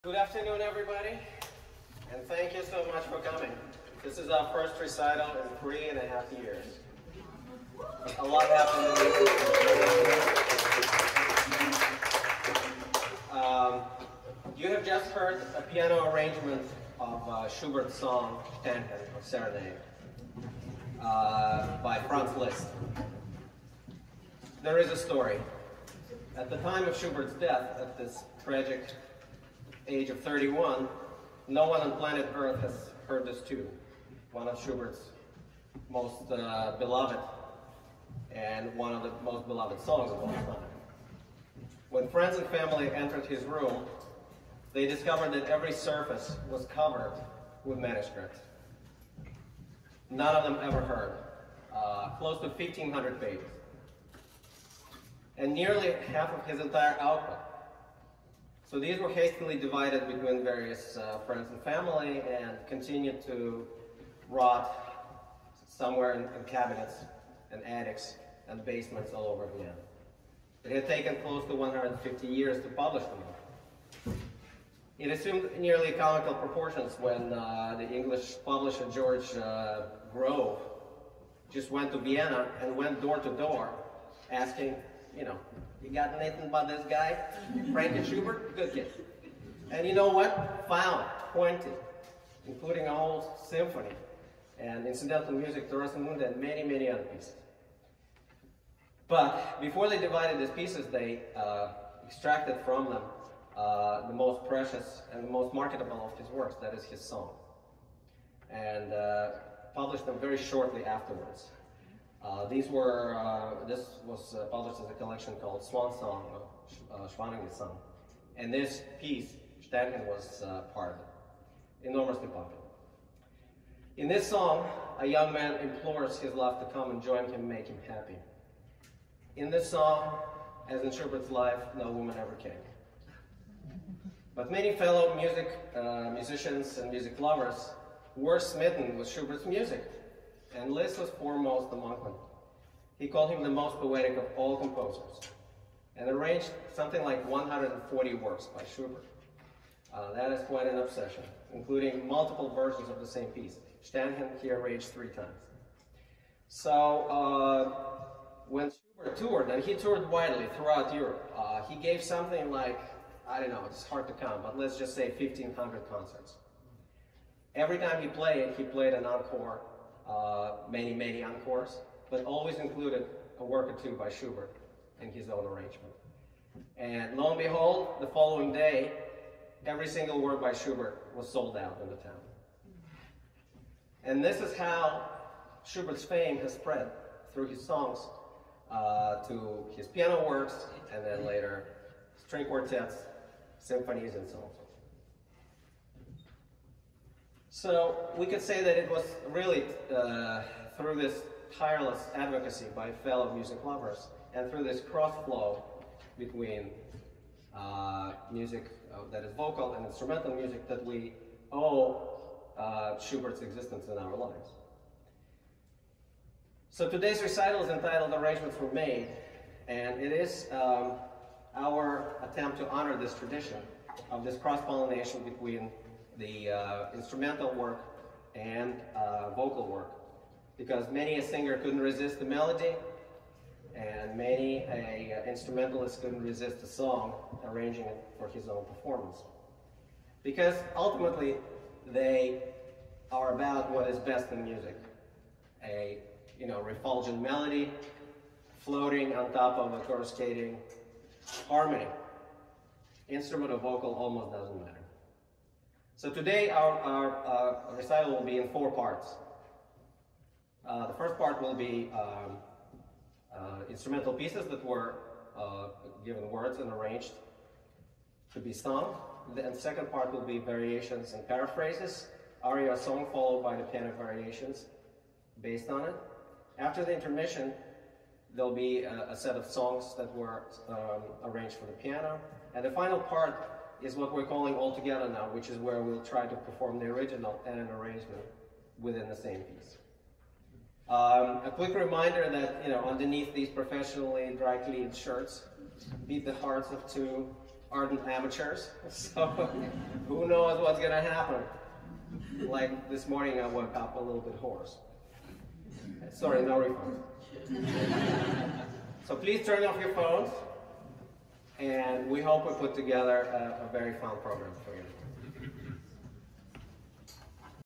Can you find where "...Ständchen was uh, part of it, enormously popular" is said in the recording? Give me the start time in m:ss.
1:59.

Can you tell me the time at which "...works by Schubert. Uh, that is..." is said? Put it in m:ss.
2:28.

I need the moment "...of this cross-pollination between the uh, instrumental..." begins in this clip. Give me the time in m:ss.
3:44.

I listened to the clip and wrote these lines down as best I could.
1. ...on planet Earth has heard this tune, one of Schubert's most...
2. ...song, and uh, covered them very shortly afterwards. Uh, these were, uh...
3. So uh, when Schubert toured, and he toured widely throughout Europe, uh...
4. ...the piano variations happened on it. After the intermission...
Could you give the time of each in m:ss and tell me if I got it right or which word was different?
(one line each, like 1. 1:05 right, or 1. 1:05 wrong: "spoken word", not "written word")
1. 0:31 right
2. 1:47 wrong: "published", not "covered"
3. 2:36 right
4. 4:33 wrong: "based", not "happened".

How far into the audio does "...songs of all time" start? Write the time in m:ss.
0:39.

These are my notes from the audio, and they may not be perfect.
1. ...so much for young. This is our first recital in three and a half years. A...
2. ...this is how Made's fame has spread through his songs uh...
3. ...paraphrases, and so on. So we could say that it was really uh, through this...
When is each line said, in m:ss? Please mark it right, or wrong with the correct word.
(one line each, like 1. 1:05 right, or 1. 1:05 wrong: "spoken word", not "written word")
1. 0:02 wrong: "coming", not "young"
2. 3:04 wrong: "Schubert", not "Made"
3. 3:13 wrong: "symphonies", not "paraphrases".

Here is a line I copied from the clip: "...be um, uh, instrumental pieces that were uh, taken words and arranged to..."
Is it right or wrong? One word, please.
wrong.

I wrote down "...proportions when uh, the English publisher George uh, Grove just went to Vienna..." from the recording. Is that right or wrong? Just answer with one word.
right.